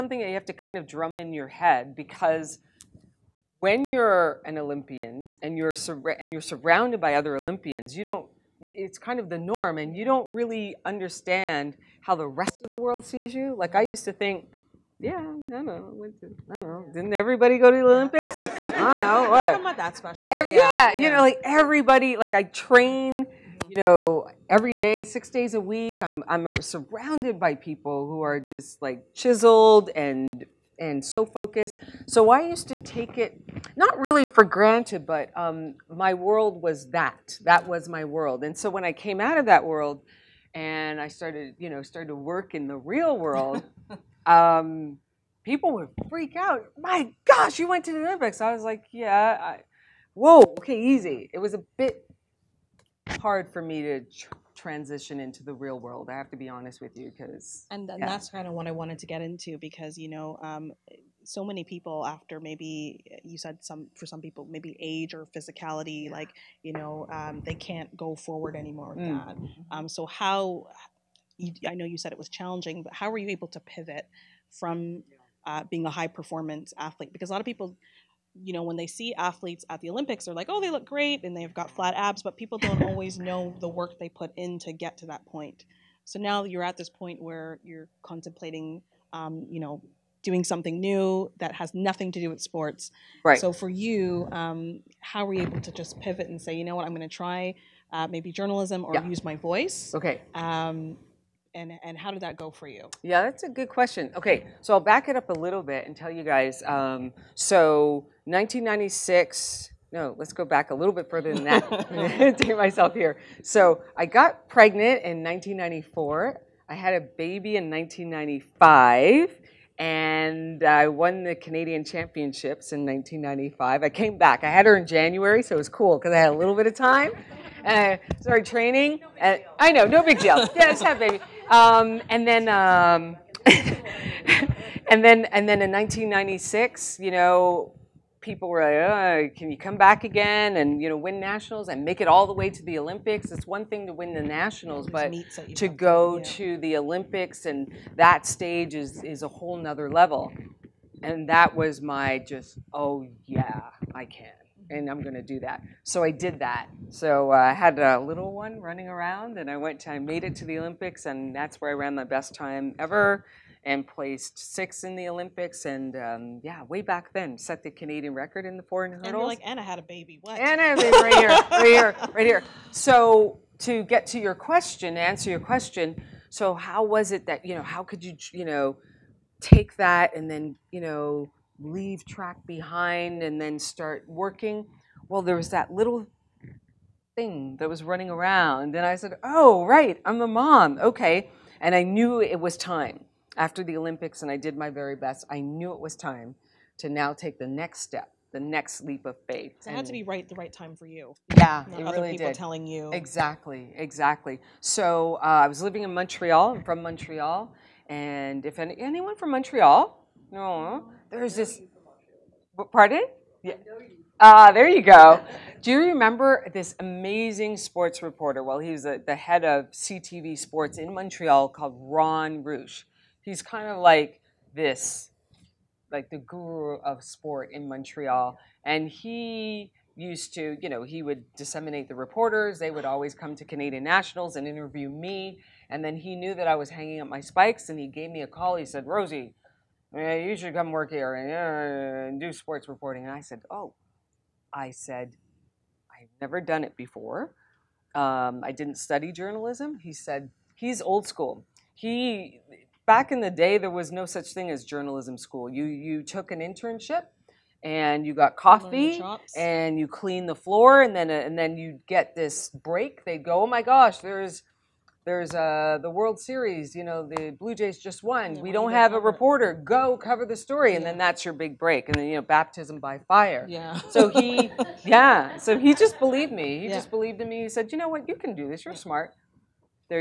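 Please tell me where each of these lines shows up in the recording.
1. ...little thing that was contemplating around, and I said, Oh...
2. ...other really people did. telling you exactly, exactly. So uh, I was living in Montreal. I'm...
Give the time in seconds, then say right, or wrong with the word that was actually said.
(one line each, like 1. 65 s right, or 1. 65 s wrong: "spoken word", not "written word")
1. 185 s wrong: "running", not "contemplating"
2. 201 s right.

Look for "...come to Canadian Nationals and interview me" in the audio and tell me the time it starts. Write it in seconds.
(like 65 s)
233 s.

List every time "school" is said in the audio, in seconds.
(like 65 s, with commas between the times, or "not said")
251 s, 255 s.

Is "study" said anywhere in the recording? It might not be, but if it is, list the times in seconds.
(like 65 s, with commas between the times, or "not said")
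248 s.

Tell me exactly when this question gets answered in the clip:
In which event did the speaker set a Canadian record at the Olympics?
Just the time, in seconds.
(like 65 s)
168 s.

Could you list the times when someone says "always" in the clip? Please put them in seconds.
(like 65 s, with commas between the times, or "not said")
82 s, 232 s.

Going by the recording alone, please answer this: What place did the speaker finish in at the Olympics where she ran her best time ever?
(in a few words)
6th.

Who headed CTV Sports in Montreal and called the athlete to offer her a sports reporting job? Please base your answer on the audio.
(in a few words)
Ron Reusch.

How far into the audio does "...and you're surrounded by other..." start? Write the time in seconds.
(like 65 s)
6 s.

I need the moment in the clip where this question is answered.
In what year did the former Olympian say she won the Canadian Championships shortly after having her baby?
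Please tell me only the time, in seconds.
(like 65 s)
121 s.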